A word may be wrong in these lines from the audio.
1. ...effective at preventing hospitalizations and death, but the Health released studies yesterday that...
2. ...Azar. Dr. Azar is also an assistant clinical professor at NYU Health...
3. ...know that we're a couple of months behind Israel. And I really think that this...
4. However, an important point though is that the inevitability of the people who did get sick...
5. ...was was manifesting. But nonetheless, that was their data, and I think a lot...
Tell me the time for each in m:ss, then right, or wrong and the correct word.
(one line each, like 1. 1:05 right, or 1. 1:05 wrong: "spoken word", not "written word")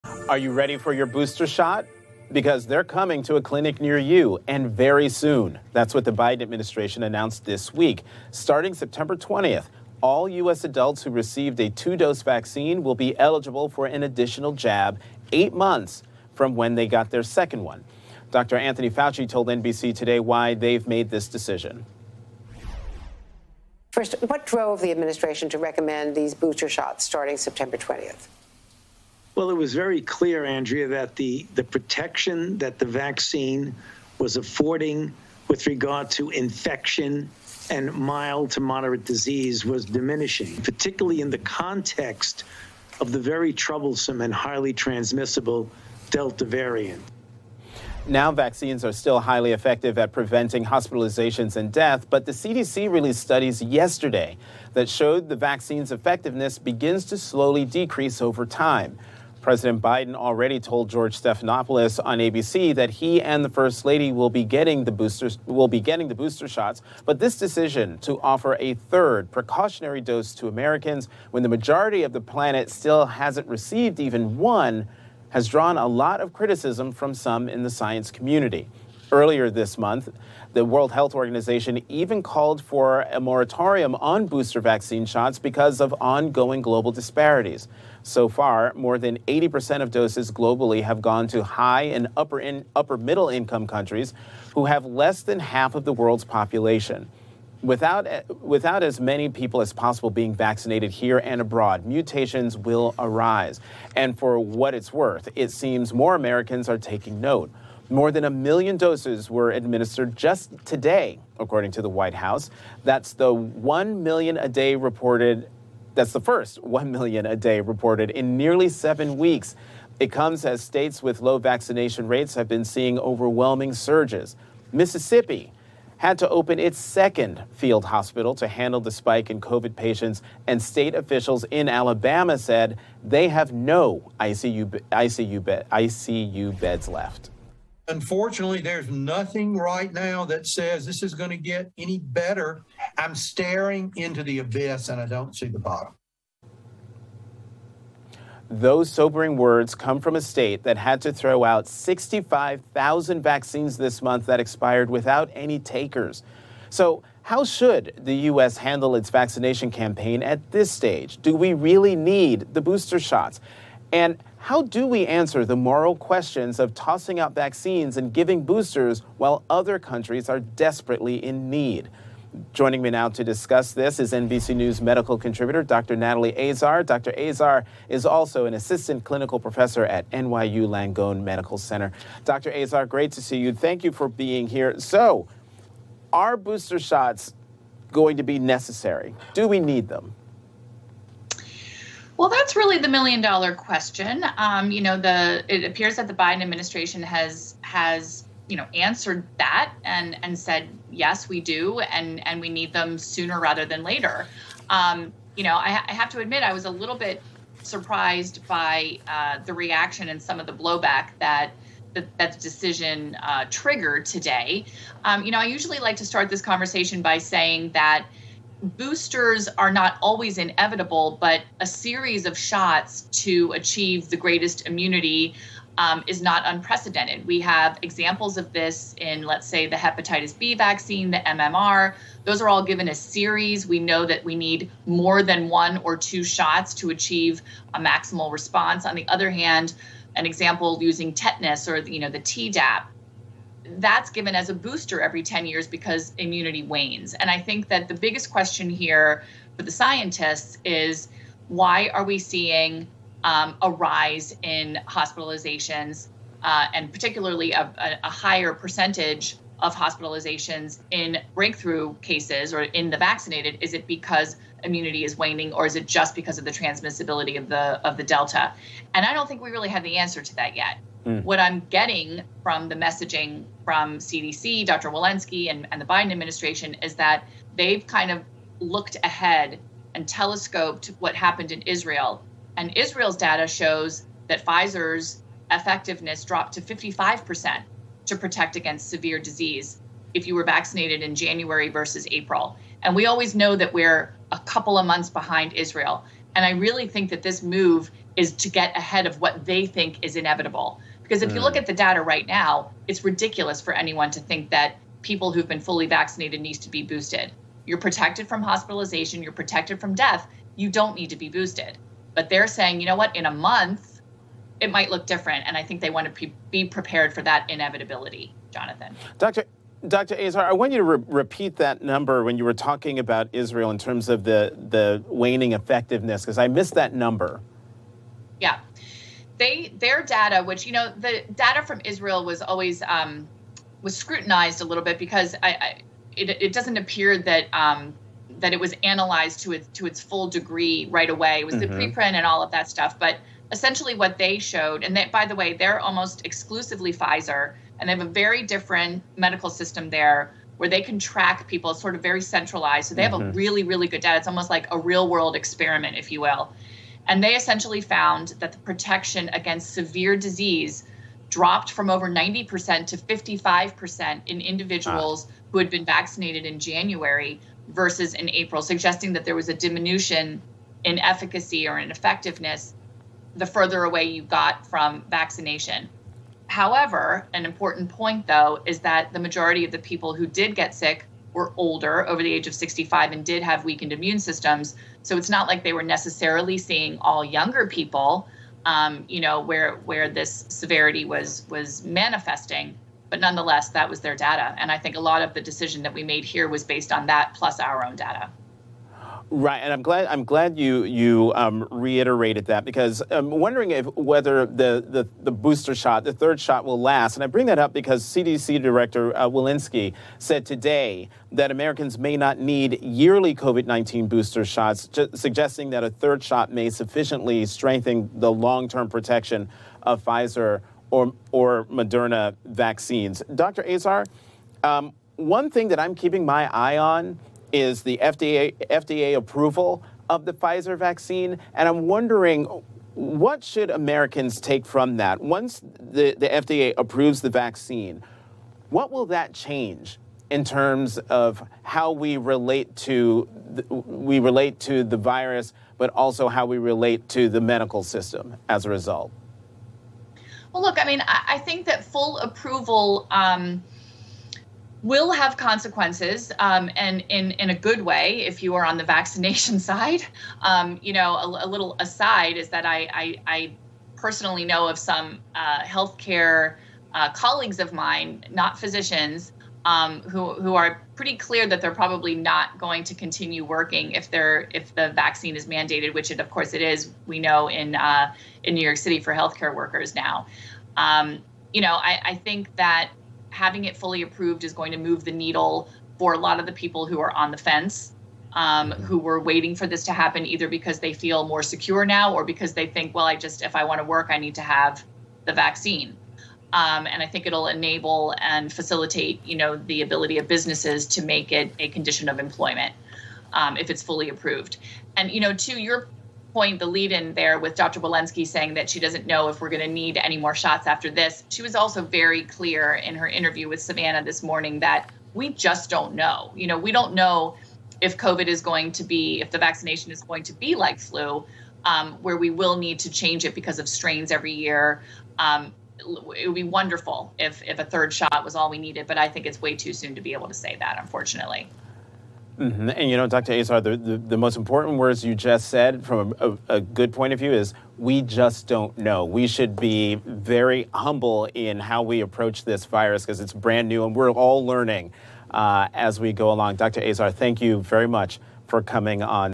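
1. 0:49 wrong: "CDC", not "Health"
2. 2:56 wrong: "Langone", not "Health"
3. 4:53 right
4. 6:16 wrong: "majority", not "inevitability"
5. 6:31 right.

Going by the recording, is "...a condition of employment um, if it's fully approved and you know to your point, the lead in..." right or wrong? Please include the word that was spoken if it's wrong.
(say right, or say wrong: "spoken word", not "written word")
right.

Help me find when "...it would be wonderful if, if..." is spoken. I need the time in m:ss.
8:45.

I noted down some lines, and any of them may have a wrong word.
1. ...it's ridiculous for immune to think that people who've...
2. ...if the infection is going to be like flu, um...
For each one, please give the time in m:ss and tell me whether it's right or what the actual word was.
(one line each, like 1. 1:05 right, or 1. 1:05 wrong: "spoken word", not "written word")
1. 5:02 wrong: "anyone", not "immune"
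2. 8:39 wrong: "vaccination", not "infection".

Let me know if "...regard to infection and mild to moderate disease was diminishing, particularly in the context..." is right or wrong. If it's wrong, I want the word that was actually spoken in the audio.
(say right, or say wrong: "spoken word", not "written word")
right.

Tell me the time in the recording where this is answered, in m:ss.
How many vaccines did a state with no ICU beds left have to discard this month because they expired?
2:31.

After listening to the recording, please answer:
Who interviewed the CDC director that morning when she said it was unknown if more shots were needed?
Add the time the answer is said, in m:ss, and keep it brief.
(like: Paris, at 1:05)
Savannah, at 8:33.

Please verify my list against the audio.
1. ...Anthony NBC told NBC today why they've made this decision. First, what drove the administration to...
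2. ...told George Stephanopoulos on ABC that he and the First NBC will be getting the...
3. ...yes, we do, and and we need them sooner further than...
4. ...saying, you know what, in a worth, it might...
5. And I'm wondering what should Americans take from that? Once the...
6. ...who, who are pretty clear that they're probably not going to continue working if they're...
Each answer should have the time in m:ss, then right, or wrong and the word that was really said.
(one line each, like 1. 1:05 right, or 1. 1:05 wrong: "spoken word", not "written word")
1. 0:18 wrong: "Fauci", not "NBC"
2. 1:00 wrong: "Lady", not "NBC"
3. 3:20 wrong: "rather", not "further"
4. 5:12 wrong: "month", not "worth"
5. 7:11 right
6. 7:50 right.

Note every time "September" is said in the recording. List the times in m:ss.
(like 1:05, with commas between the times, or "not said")
0:08, 0:27.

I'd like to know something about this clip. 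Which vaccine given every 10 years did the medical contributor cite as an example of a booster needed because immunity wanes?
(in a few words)
Tdap.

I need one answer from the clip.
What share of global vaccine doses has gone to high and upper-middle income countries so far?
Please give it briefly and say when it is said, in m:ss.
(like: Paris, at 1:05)
more than 80%, at 1:28.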